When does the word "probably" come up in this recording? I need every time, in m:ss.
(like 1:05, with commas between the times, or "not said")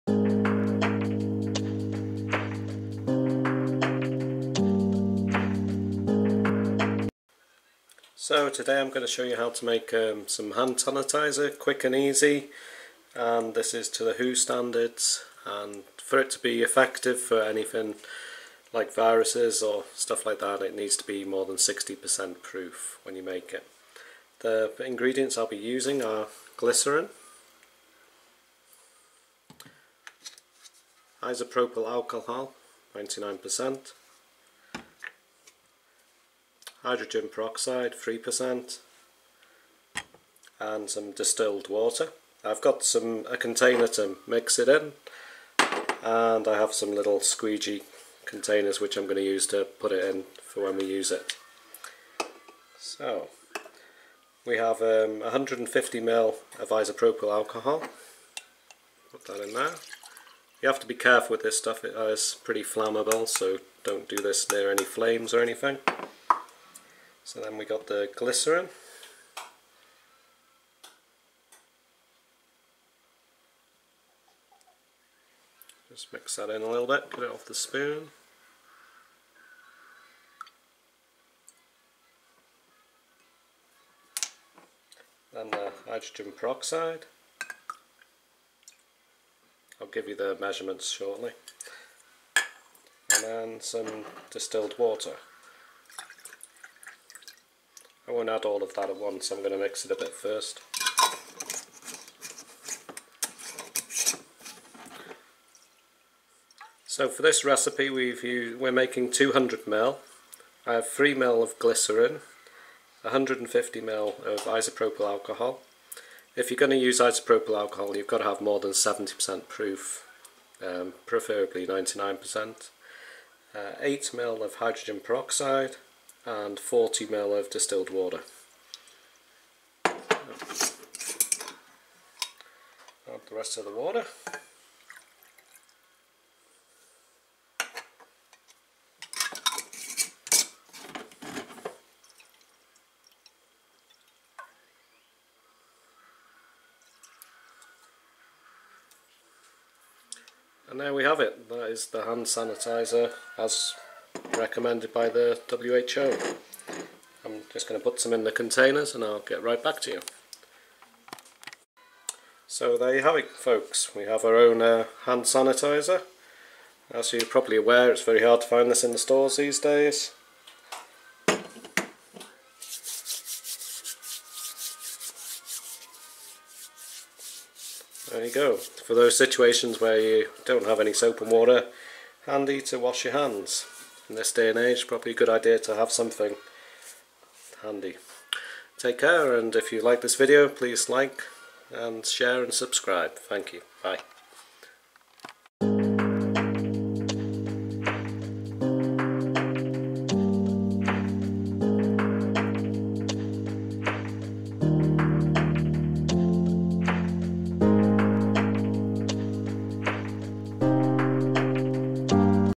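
2:47, 3:04.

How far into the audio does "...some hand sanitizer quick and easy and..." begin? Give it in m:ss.
0:10.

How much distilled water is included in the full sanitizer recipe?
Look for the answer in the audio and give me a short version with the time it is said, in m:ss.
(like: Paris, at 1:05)
40 ml, at 2:06.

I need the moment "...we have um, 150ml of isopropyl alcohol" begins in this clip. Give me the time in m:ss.
0:54.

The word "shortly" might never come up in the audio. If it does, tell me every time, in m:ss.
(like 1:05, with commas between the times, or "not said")
1:30.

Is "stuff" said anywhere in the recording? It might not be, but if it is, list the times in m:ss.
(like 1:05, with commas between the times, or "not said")
0:19, 1:01.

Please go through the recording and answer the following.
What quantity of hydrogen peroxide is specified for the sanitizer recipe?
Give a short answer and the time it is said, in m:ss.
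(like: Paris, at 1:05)
8ml, at 2:03.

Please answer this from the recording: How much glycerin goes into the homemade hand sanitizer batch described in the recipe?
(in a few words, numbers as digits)
3ml.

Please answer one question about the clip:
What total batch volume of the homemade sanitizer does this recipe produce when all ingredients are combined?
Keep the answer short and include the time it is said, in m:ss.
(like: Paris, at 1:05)
200ml, at 1:49.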